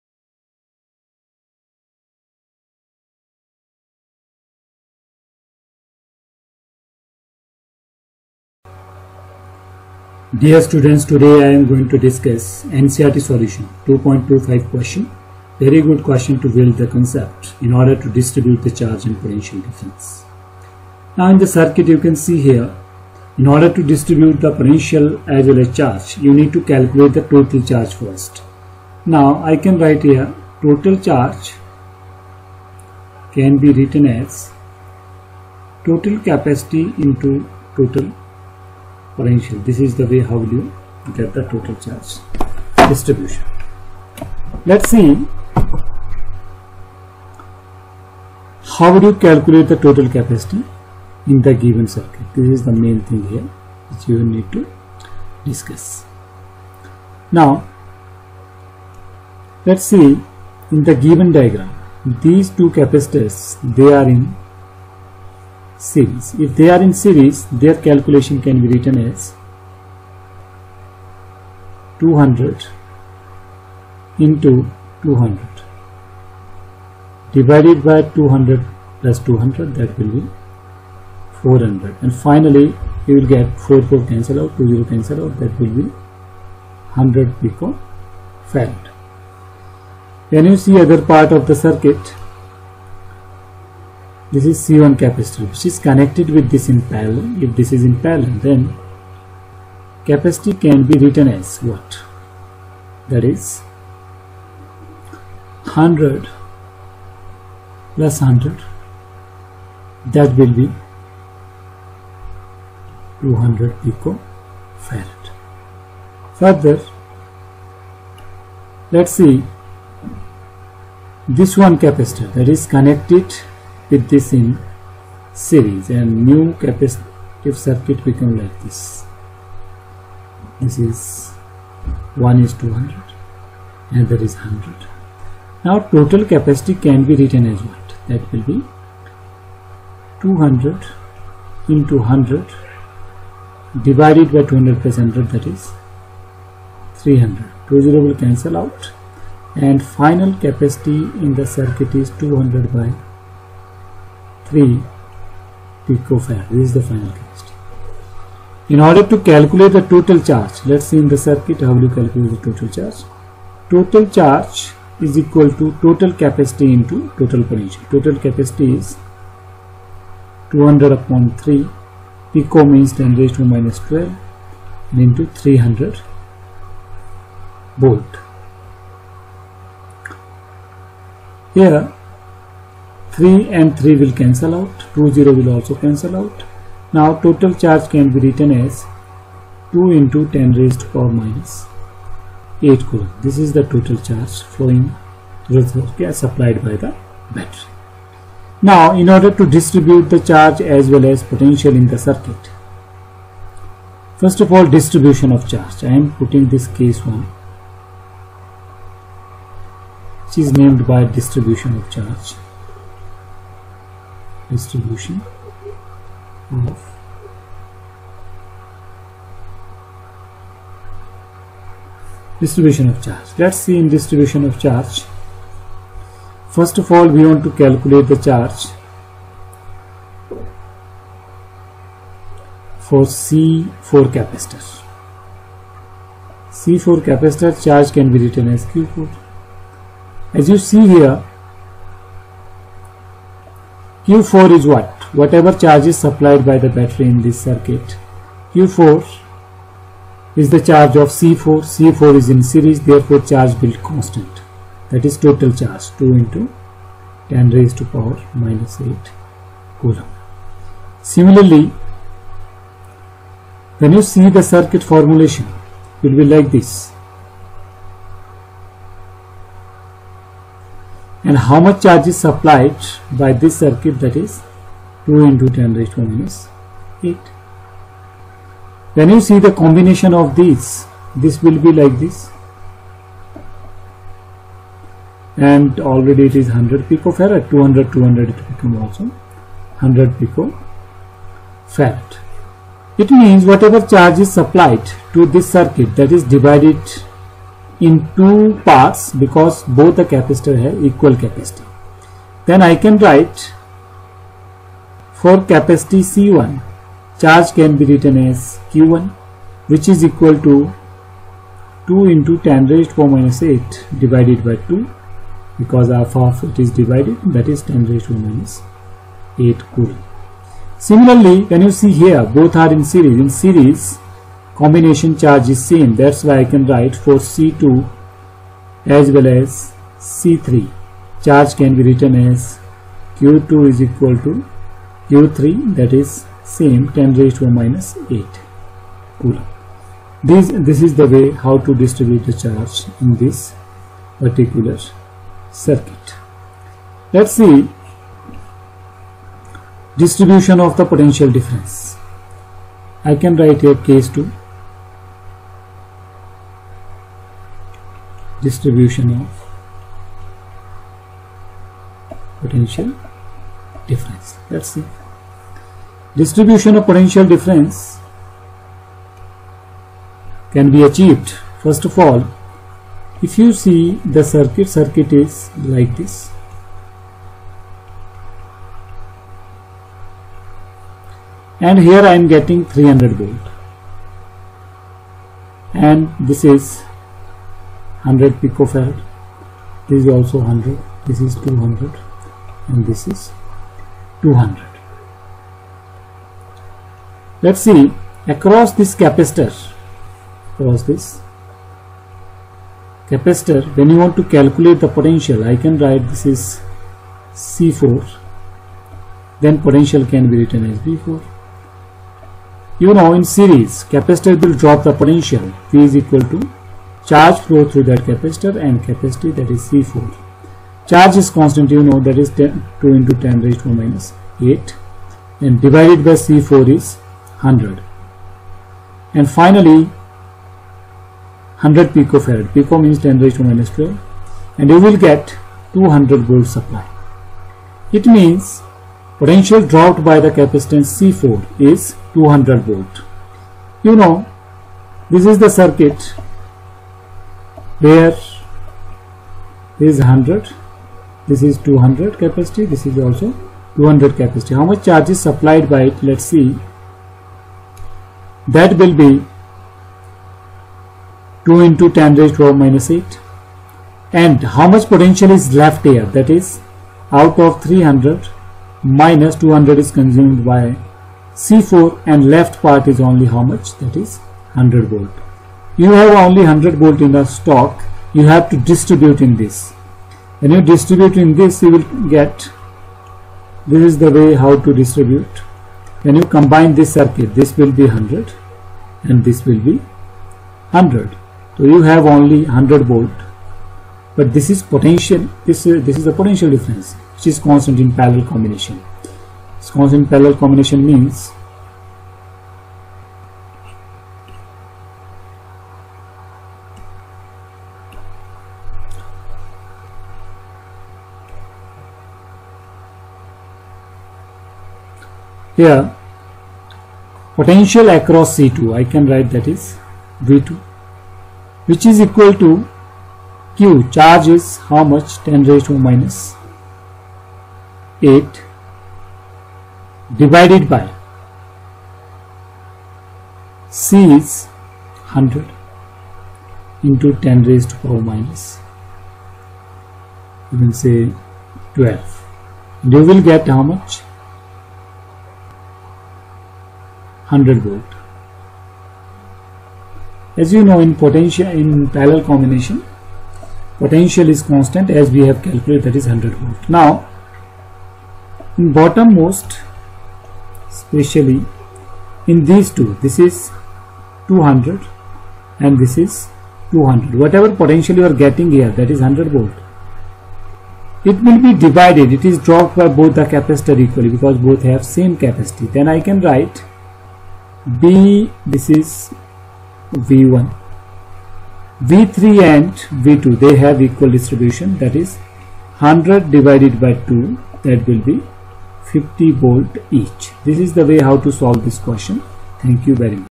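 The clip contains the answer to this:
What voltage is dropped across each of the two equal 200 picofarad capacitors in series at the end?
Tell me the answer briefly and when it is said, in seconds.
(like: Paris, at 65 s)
50 volts, at 588 s.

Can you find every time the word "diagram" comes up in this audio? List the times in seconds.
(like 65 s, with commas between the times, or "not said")
61 s.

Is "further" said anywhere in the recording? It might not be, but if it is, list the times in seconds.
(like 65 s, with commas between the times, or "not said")
116 s.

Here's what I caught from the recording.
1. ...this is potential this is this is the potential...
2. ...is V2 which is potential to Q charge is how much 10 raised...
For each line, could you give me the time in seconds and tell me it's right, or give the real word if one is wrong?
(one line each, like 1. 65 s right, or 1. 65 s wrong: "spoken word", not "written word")
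1. 494 s right
2. 519 s wrong: "equal", not "potential".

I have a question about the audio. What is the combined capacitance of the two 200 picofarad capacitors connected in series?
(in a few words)
100 picofarad.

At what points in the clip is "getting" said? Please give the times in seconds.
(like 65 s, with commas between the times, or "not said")
382 s, 568 s.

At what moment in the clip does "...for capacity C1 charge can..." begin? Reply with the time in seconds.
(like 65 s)
305 s.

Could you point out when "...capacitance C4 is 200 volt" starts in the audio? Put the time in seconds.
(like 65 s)
440 s.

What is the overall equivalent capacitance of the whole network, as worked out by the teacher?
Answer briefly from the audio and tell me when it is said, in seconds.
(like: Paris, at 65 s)
200/3 picofarad, at 152 s.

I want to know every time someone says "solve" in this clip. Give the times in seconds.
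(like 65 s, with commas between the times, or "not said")
591 s.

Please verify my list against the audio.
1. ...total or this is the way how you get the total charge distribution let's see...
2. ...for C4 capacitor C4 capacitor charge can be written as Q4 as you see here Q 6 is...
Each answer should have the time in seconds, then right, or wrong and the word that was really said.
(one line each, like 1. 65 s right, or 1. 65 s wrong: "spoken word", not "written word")
1. 37 s right
2. 232 s wrong: "4", not "6".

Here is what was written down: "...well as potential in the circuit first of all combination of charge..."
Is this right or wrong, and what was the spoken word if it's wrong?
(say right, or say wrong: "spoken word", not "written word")
wrong: "distribution", not "combination".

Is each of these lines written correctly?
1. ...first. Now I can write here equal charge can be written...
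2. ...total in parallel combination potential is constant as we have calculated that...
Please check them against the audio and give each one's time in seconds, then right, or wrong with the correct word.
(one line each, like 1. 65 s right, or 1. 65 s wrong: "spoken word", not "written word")
1. 27 s wrong: "total", not "equal"
2. 550 s wrong: "potential", not "total".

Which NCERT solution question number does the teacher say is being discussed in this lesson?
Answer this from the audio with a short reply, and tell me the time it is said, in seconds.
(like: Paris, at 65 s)
2.25, at 13 s.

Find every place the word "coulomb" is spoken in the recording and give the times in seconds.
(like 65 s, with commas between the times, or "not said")
192 s, 259 s, 319 s, 339 s.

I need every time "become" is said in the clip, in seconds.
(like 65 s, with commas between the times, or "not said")
128 s, 288 s.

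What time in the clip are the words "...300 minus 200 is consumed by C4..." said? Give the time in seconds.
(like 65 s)
467 s.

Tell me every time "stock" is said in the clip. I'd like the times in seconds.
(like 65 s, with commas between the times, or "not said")
477 s.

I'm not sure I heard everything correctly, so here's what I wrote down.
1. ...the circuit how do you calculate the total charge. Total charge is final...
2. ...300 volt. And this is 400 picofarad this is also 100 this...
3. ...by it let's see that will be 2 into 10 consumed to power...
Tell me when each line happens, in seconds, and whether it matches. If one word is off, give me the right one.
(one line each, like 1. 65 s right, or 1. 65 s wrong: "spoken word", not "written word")
1. 161 s wrong: "equal", not "final"
2. 382 s wrong: "100", not "400"
3. 455 s wrong: "raised", not "consumed".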